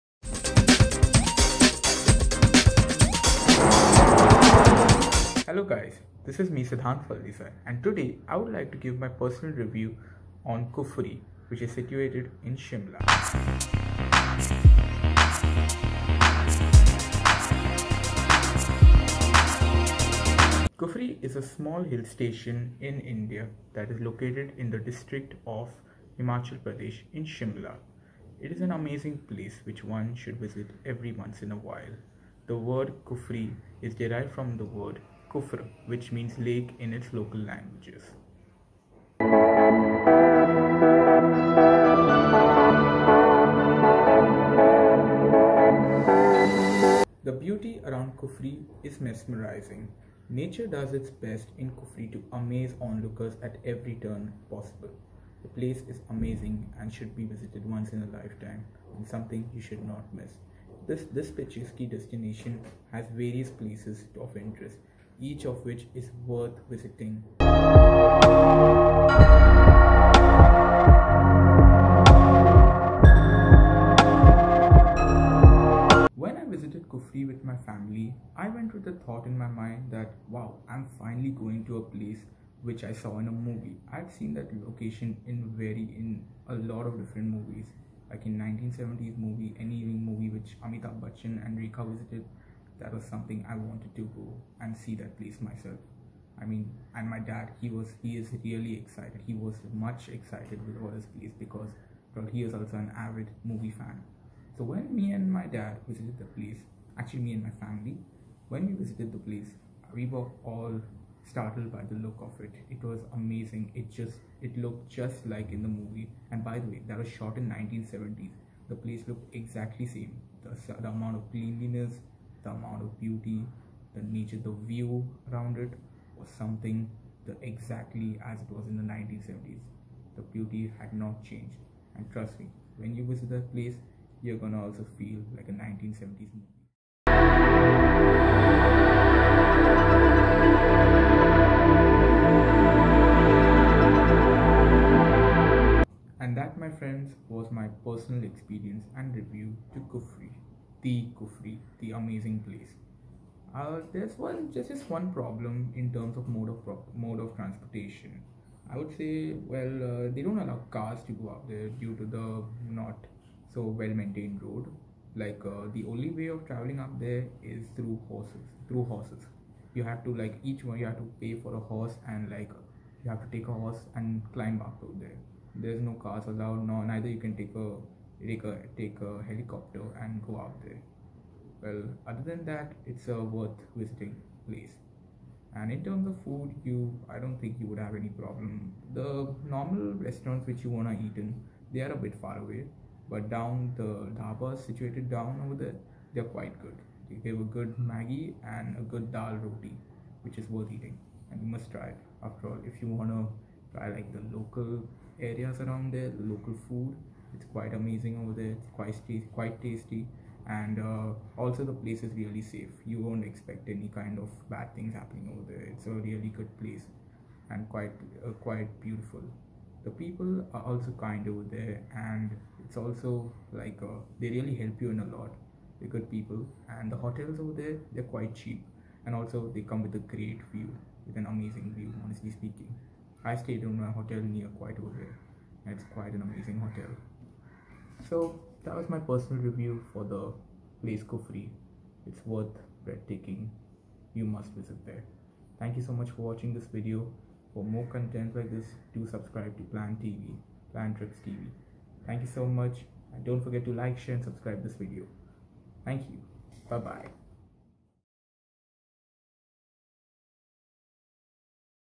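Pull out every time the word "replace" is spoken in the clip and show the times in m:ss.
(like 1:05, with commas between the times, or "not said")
not said.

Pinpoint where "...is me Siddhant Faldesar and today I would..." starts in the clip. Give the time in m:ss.
0:06.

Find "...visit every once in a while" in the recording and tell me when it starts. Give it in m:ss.
0:30.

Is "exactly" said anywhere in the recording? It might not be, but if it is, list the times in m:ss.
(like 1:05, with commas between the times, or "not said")
1:59, 2:07.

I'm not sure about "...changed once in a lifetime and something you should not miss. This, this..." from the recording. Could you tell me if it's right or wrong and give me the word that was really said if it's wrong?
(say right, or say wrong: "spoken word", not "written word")
wrong: "visited", not "changed".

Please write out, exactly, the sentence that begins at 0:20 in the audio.
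Kufri is a small hill station in India that is located in the district of Himachal Pradesh in Shimla.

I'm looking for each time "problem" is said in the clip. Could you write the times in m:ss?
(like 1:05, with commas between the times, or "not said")
2:35, 3:08.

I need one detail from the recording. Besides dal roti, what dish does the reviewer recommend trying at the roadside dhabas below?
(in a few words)
Maggi.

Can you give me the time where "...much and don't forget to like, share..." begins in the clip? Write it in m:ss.
4:12.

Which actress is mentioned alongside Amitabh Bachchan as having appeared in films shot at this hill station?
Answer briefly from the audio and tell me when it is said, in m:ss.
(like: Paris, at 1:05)
Rekha, at 1:31.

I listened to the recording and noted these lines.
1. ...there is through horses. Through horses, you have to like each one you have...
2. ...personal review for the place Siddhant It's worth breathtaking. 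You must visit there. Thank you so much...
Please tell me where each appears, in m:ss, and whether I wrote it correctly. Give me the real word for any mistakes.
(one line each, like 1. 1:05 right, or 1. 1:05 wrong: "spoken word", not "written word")
1. 2:46 right
2. 3:58 wrong: "Kufri", not "Siddhant".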